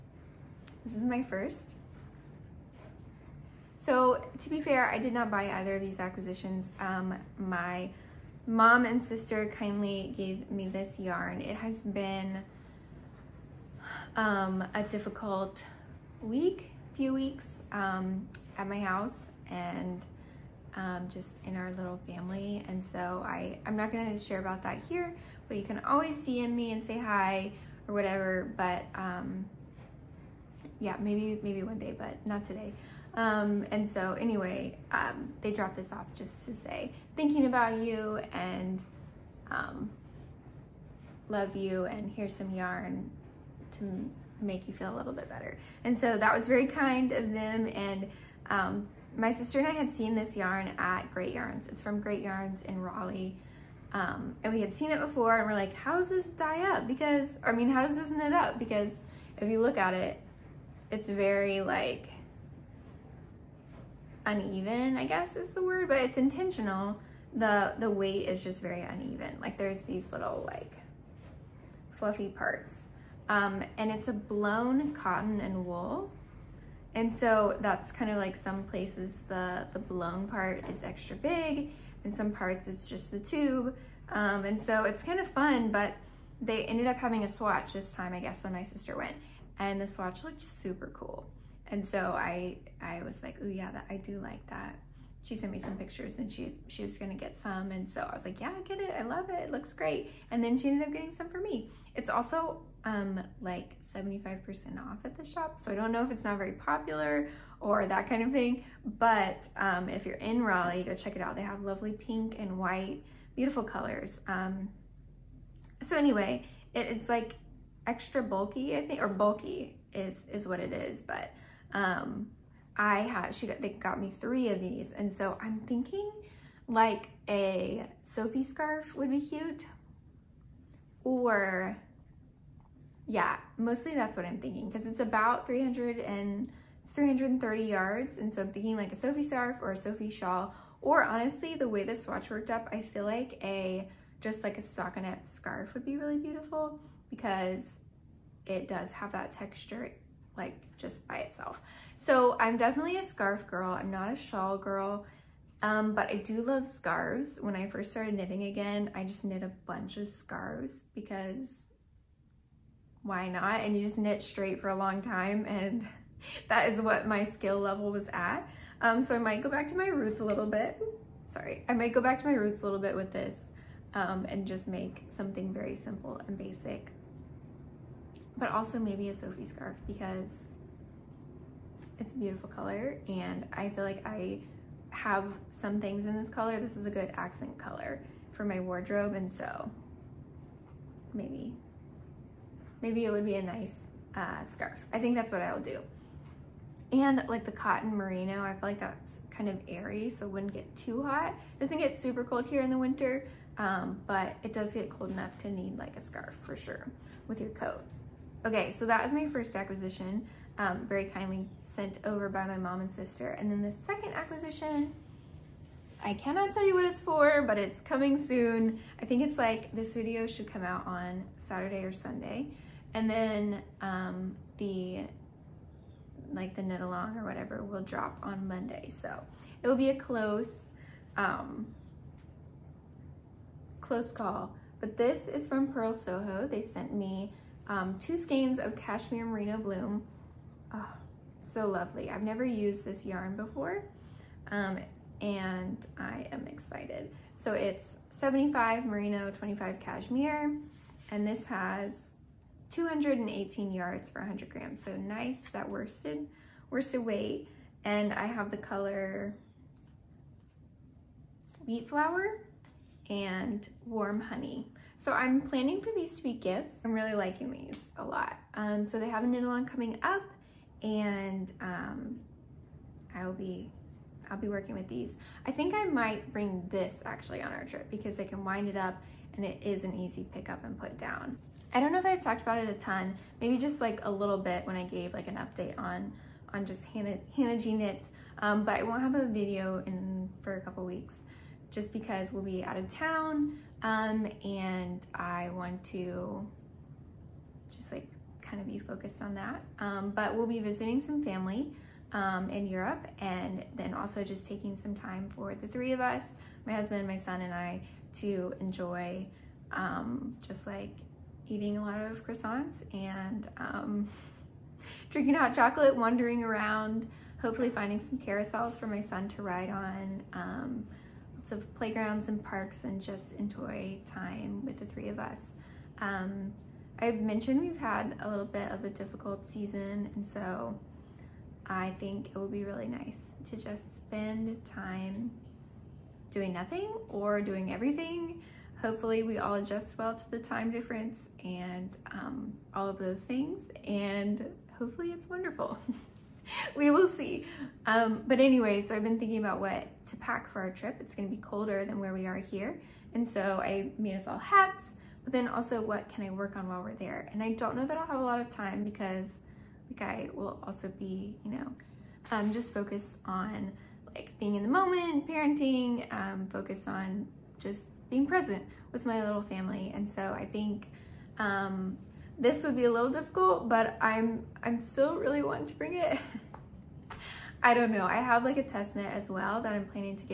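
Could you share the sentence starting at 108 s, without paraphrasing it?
But um, if you're in Raleigh, go check it out.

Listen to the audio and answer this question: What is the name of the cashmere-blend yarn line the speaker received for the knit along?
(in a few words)
Cashmere Merino Bloom.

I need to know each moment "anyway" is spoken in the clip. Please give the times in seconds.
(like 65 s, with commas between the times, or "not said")
34 s, 115 s, 348 s.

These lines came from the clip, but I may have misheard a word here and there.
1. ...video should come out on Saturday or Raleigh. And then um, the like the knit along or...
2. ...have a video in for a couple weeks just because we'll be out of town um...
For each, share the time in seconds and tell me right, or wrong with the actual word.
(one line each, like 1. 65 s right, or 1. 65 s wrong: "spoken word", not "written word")
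1. 219 s wrong: "Sunday", not "Raleigh"
2. 289 s right.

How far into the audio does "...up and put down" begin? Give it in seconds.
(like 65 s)
280 s.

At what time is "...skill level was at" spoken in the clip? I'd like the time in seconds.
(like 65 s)
167 s.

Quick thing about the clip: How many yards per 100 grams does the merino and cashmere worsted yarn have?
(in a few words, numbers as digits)
218.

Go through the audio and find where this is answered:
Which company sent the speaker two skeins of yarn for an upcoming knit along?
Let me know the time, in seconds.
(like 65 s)
235 s.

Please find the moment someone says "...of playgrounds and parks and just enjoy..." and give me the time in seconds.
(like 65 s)
321 s.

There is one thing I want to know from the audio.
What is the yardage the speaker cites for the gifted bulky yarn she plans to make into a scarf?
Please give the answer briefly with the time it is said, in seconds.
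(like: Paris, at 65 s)
330 yards, at 136 s.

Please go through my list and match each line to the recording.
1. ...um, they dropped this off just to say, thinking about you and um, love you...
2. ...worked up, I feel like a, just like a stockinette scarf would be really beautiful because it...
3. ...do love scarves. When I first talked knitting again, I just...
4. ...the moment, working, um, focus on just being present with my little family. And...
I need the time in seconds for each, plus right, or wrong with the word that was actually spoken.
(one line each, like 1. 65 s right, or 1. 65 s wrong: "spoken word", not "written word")
1. 34 s right
2. 142 s right
3. 156 s wrong: "started", not "talked"
4. 364 s wrong: "parenting", not "working".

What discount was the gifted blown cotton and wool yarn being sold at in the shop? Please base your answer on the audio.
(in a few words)
75% off.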